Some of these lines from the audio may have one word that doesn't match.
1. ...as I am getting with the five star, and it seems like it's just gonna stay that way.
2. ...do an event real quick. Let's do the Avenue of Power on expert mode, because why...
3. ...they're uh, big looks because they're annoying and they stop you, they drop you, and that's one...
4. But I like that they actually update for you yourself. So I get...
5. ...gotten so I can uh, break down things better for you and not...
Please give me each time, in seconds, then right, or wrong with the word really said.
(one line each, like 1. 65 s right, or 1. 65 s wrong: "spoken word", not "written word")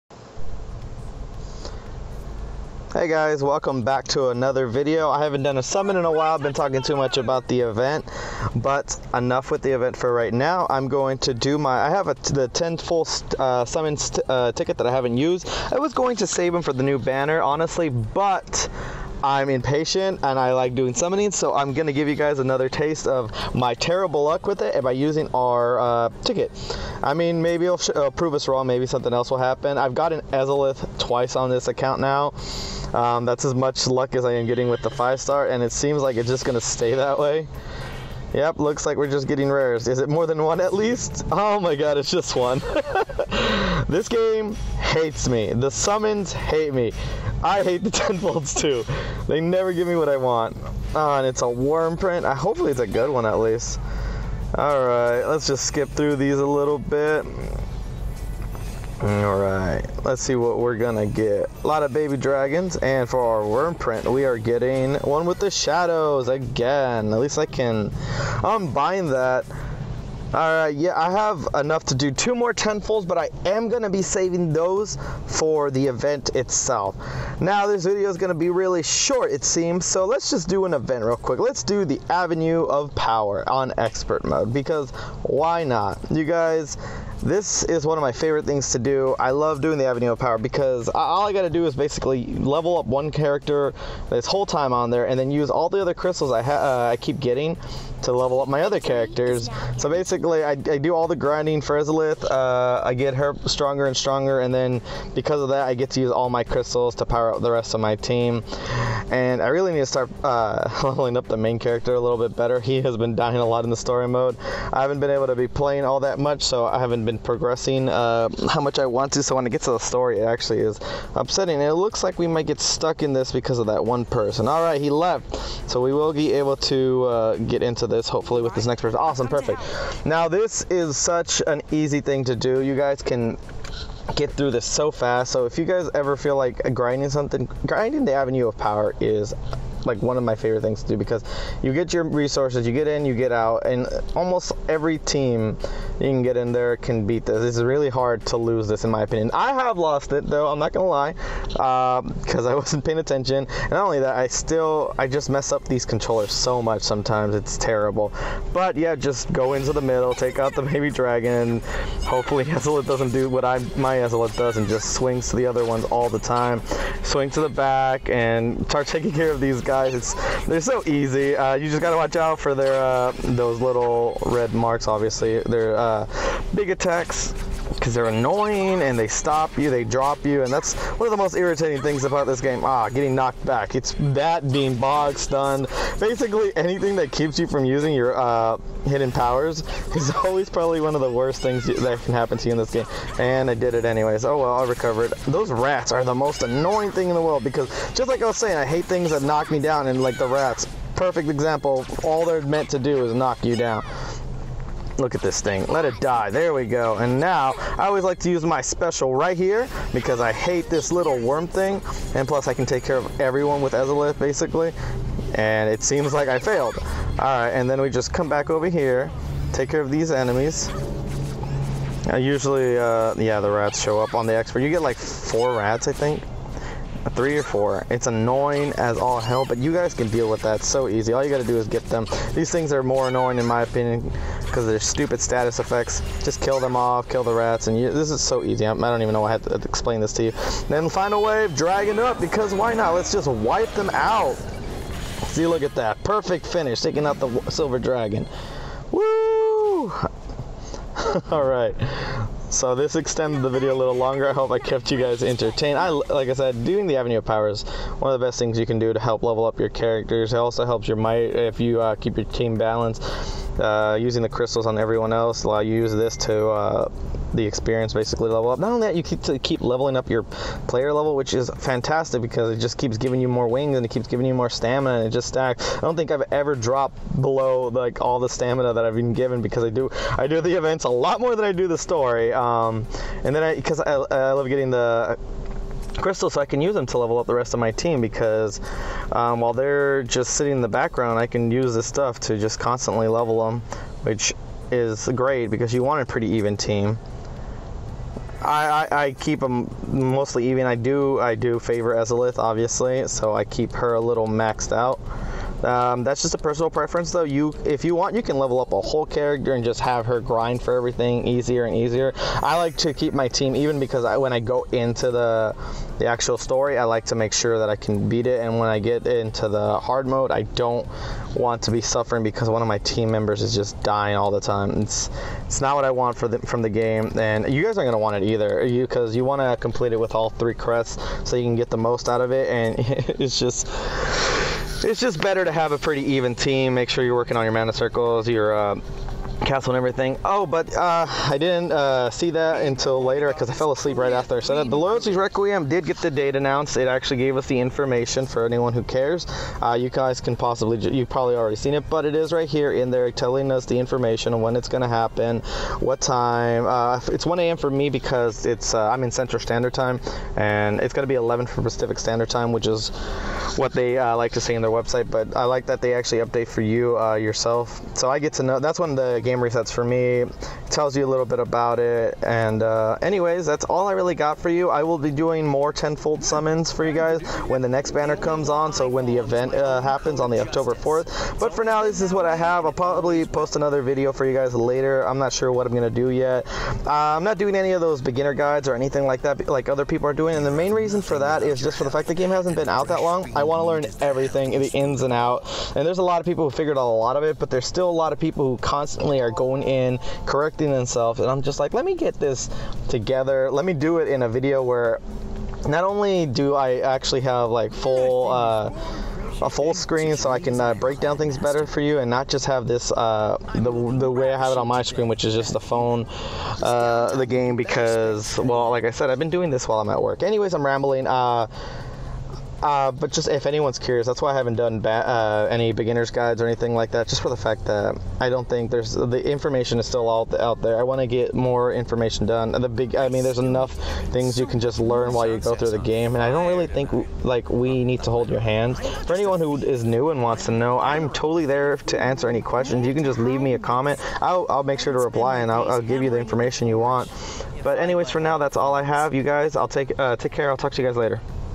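1. 34 s right
2. 80 s right
3. 175 s wrong: "attacks", not "looks"
4. 365 s right
5. 409 s wrong: "screen", not "gotten".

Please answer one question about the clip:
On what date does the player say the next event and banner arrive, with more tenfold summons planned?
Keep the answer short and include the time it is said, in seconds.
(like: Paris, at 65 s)
October 4, at 380 s.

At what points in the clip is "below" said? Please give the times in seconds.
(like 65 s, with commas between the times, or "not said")
277 s.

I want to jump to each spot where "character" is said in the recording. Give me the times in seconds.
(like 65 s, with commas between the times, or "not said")
93 s, 98 s, 111 s, 259 s, 309 s.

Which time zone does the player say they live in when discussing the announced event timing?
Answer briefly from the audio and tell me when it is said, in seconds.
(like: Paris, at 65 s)
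Central Standard Time, at 359 s.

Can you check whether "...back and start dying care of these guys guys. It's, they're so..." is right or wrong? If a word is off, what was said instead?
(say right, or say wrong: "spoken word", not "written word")
wrong: "taking", not "dying".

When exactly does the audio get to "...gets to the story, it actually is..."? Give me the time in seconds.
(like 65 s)
119 s.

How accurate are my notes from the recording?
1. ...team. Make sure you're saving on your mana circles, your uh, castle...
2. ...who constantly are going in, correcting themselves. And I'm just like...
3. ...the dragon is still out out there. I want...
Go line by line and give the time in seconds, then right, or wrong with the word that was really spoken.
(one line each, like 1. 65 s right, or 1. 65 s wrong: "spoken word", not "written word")
1. 336 s wrong: "working", not "saving"
2. 398 s right
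3. 428 s wrong: "information", not "dragon".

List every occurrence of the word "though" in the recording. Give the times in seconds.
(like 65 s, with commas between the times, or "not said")
150 s, 307 s.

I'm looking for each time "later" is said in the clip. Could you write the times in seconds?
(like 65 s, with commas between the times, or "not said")
343 s, 384 s, 450 s.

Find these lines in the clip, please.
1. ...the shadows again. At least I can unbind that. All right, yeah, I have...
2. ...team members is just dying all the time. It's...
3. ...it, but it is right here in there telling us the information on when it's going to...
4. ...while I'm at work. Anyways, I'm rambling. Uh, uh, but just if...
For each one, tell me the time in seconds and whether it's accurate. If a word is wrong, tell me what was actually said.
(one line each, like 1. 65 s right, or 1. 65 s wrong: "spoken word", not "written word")
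1. 65 s right
2. 322 s right
3. 351 s right
4. 419 s right.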